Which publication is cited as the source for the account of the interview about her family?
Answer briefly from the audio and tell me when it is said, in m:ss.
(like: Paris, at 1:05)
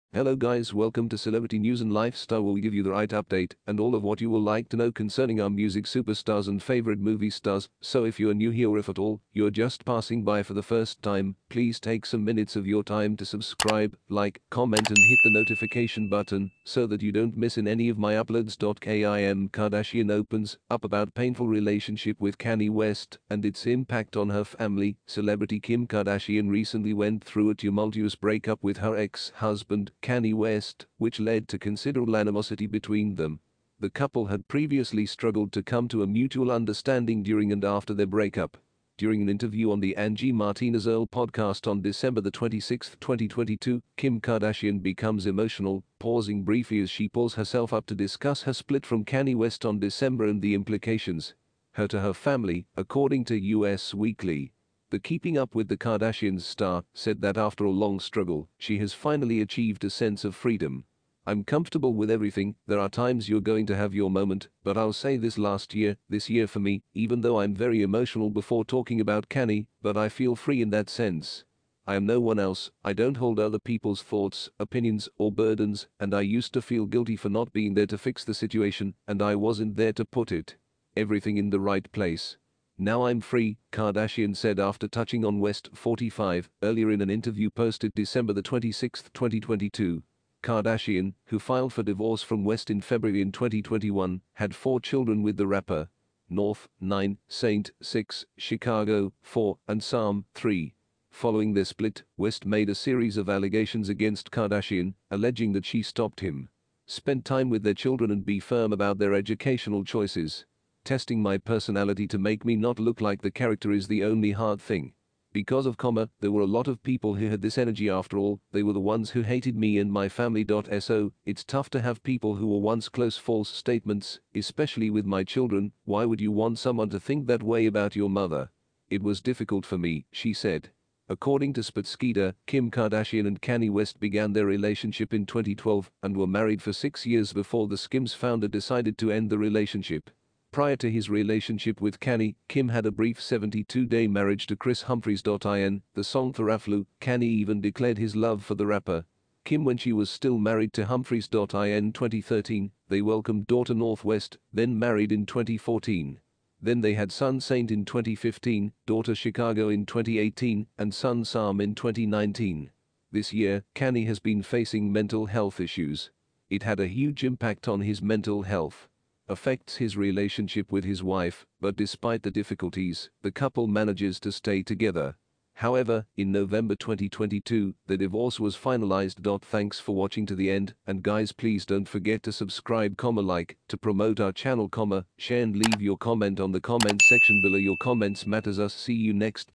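US Weekly, at 0:53.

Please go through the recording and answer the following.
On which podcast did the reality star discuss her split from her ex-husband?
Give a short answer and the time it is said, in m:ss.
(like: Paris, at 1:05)
Angie Martinez IRL, at 0:39.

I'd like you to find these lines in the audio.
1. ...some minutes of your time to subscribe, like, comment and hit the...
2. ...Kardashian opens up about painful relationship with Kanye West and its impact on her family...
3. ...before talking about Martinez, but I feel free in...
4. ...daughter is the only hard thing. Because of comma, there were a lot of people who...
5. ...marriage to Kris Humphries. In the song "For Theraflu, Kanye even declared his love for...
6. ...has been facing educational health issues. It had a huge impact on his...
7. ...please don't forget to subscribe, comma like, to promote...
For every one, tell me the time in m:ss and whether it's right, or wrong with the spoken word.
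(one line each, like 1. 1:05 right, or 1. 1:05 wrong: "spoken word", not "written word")
1. 0:12 right
2. 0:19 right
3. 1:08 wrong: "Kanye", not "Martinez"
4. 1:53 wrong: "character", not "daughter"
5. 2:24 right
6. 2:44 wrong: "mental", not "educational"
7. 3:01 right.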